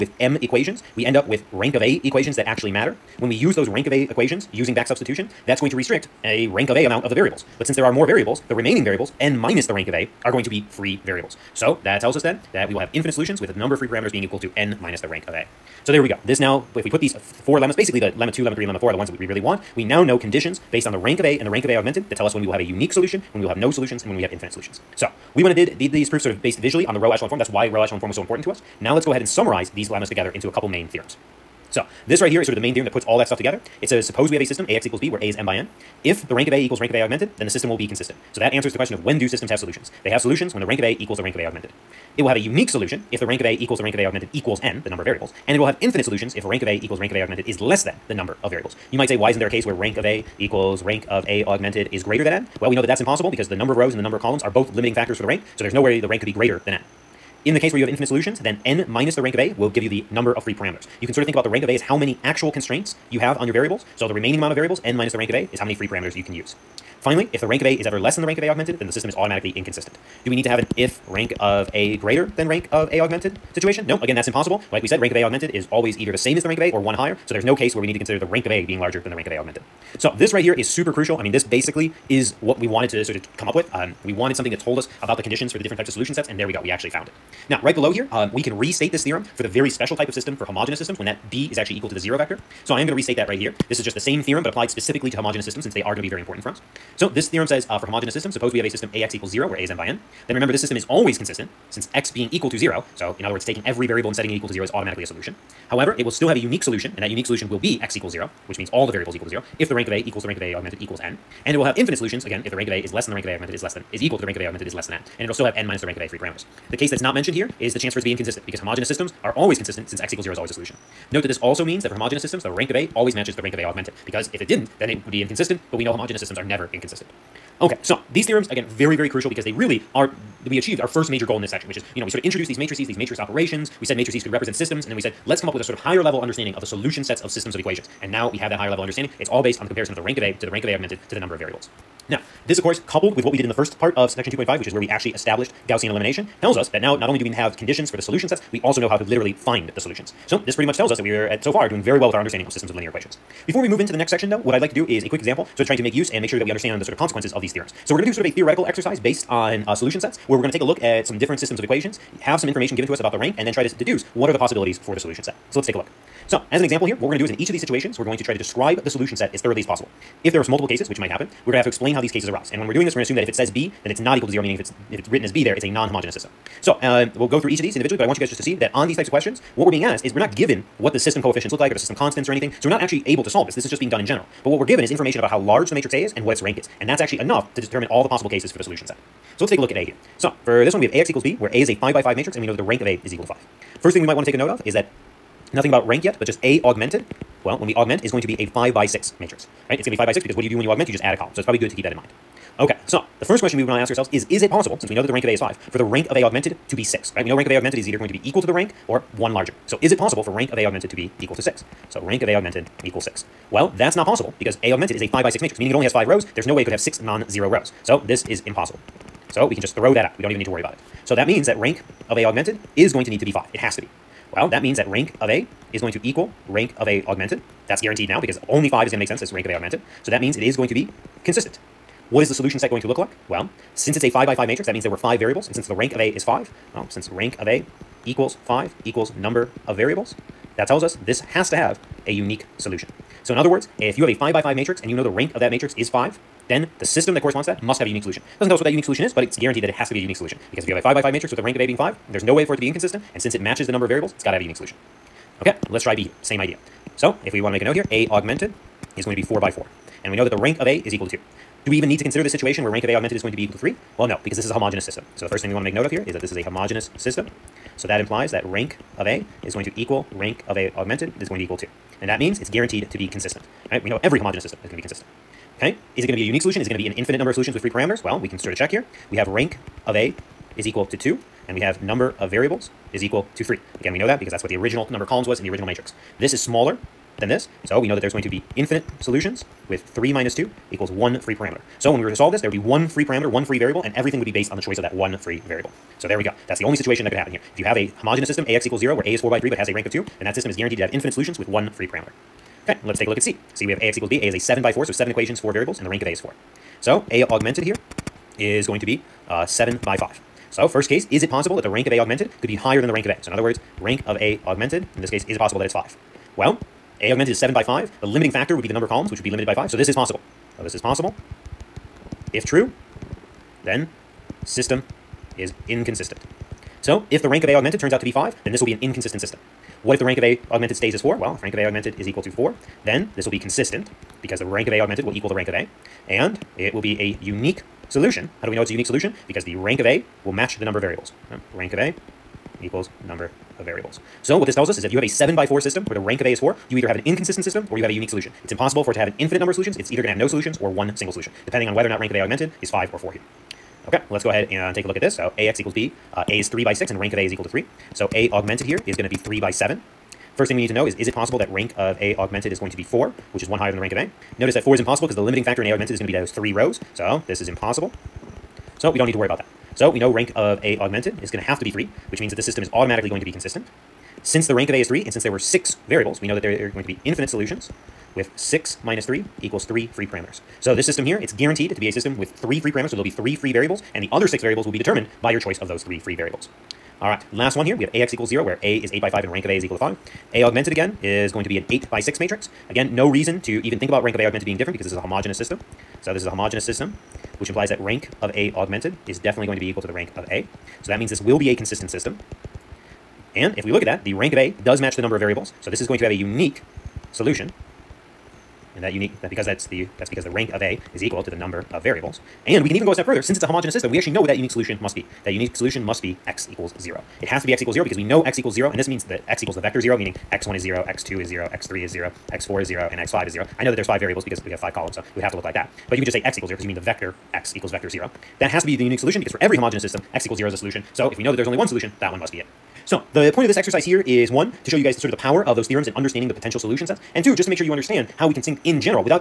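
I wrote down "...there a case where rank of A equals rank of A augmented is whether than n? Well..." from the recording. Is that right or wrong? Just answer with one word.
wrong.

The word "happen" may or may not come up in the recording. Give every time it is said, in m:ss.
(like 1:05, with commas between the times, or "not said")
2:51, 4:57.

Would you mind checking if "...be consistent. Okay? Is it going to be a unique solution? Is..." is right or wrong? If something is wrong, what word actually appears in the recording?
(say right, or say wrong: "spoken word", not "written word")
right.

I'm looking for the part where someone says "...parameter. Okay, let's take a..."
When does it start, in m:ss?
5:01.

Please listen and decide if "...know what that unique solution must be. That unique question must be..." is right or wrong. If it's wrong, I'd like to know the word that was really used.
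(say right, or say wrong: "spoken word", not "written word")
wrong: "solution", not "question".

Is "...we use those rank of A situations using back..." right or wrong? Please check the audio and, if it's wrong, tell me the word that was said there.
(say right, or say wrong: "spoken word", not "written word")
wrong: "equations", not "situations".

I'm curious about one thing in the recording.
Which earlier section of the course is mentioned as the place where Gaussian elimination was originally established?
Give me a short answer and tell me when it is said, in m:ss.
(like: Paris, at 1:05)
Section 2.5, at 2:24.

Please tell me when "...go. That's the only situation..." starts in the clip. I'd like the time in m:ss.
4:56.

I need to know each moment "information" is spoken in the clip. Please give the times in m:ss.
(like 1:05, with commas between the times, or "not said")
2:42, 3:04.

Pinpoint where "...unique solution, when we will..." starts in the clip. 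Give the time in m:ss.
0:22.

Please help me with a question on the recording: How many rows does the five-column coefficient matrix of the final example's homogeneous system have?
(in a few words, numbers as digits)
8.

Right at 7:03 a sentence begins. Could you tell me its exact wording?
I know that there's five variables because we have five columns, so it would have to look like that.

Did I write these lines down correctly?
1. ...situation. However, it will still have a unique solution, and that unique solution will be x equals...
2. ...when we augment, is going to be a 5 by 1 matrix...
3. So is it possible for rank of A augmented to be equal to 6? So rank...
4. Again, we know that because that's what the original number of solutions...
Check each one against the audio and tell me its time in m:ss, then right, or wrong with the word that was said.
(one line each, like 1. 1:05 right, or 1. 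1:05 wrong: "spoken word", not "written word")
1. 1:45 wrong: "solution", not "situation"
2. 3:17 wrong: "6", not "1"
3. 3:29 right
4. 4:43 wrong: "columns", not "solutions".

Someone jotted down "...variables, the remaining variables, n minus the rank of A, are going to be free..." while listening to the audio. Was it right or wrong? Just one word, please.
right.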